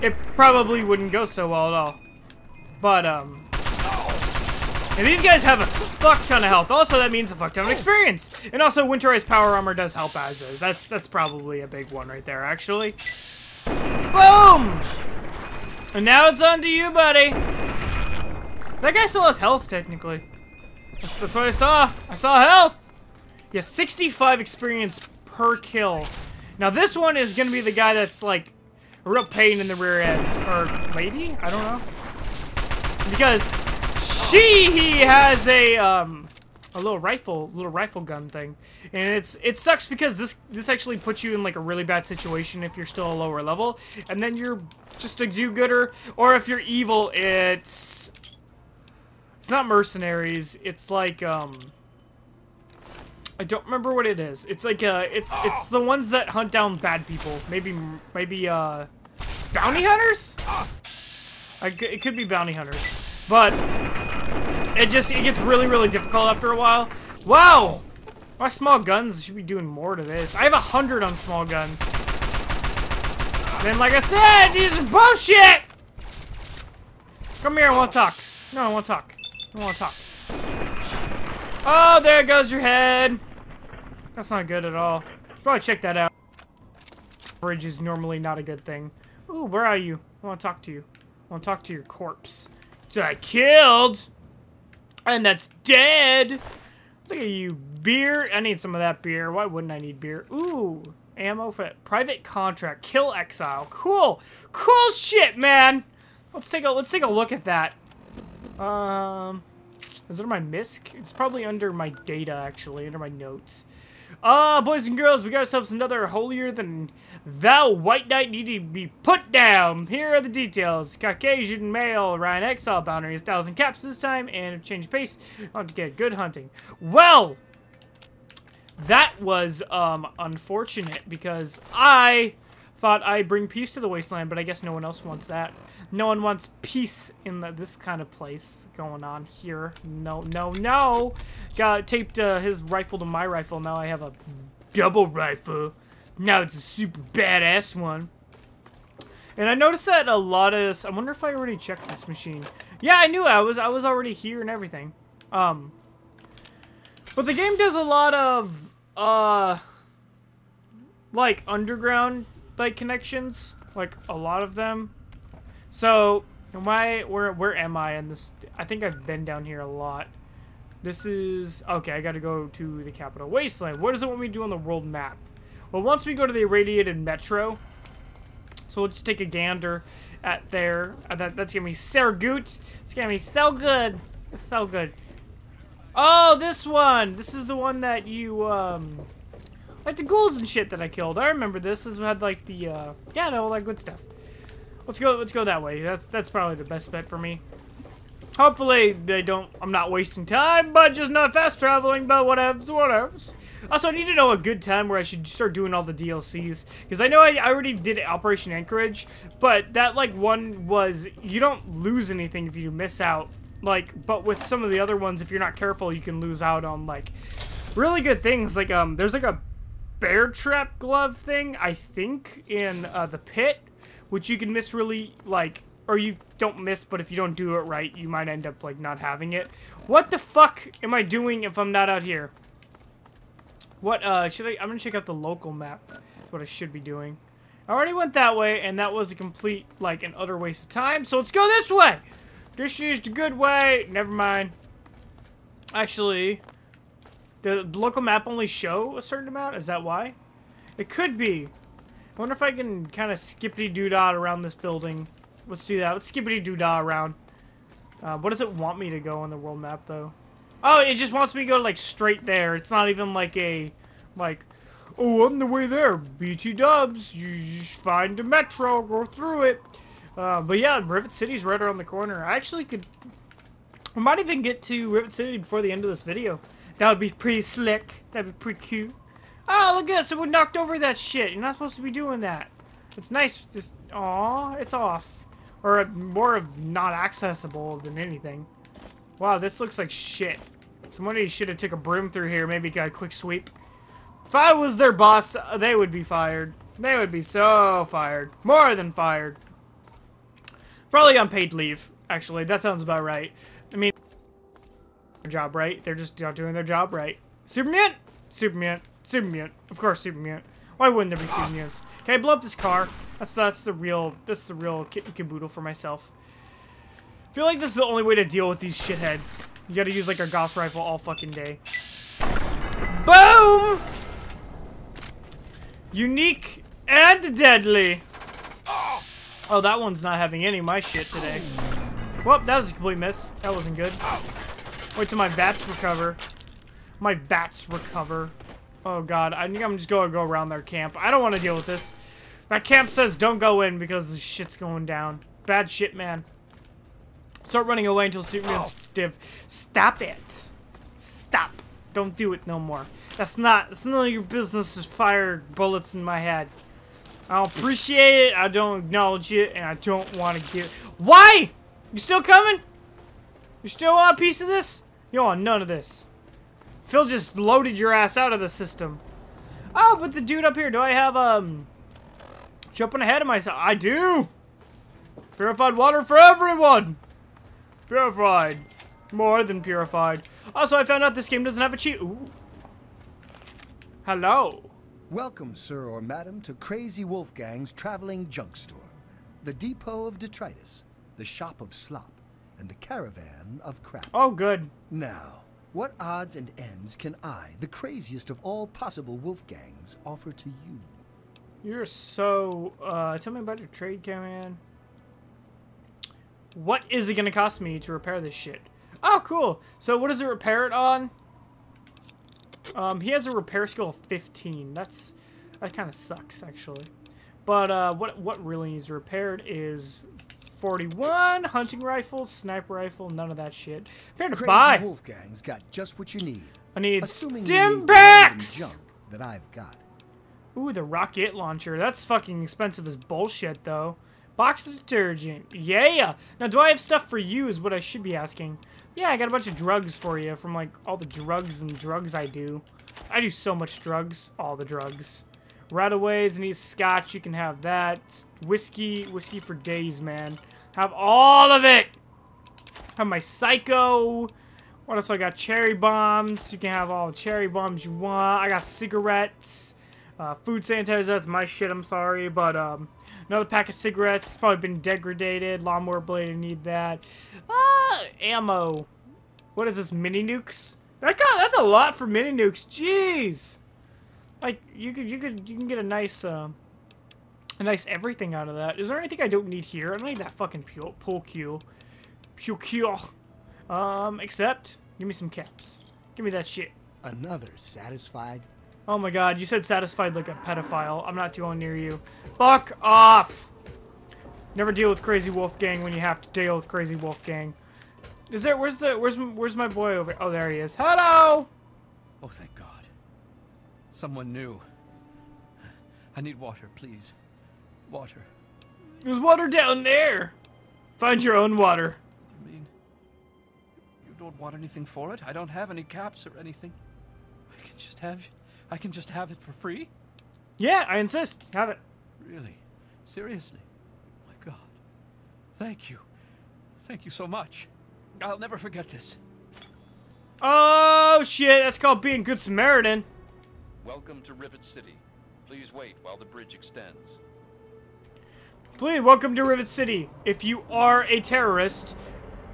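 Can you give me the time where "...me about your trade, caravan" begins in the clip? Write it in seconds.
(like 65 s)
403 s.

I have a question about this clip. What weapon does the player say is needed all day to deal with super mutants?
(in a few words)
Gauss rifle.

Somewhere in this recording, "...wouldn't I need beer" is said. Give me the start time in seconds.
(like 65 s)
99 s.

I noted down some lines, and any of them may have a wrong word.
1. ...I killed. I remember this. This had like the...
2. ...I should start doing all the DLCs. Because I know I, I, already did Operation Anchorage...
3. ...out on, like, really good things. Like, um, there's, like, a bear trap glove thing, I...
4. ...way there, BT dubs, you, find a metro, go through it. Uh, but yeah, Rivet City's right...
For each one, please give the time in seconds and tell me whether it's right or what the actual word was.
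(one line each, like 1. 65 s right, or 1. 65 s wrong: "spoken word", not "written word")
1. 190 s right
2. 204 s right
3. 216 s right
4. 265 s right.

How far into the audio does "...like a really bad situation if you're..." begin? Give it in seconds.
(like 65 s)
41 s.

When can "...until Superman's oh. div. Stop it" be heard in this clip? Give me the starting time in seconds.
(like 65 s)
348 s.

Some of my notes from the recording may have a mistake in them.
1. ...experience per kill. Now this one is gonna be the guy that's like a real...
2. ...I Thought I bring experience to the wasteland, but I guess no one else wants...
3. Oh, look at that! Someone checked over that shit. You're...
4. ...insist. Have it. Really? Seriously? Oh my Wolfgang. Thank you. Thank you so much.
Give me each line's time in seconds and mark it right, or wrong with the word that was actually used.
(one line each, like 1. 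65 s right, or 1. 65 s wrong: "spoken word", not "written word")
1. 24 s right
2. 131 s wrong: "peace", not "experience"
3. 279 s wrong: "knocked", not "checked"
4. 520 s wrong: "God", not "Wolfgang".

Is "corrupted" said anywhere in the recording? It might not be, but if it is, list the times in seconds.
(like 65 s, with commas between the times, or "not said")
not said.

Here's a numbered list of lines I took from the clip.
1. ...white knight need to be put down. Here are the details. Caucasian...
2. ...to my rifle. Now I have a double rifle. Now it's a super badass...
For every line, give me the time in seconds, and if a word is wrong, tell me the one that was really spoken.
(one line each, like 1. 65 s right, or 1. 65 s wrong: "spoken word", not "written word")
1. 117 s right
2. 142 s right.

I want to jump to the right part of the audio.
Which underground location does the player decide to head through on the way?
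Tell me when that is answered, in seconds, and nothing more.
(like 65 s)
176 s.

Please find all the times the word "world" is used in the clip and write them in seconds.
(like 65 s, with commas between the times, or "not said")
174 s, 259 s.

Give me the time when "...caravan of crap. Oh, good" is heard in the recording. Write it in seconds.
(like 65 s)
392 s.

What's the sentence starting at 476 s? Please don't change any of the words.
Uh, a nice everything out of that.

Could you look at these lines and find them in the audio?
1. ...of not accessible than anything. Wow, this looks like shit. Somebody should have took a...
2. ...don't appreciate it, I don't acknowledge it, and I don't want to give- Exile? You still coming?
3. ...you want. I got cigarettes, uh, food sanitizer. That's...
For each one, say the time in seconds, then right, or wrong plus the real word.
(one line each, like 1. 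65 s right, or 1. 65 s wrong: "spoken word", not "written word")
1. 286 s right
2. 357 s wrong: "Why", not "Exile"
3. 457 s right.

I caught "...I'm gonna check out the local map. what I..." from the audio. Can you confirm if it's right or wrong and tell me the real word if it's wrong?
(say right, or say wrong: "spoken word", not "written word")
right.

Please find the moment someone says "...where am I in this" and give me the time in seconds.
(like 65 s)
167 s.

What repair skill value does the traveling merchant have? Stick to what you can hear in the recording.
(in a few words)
15.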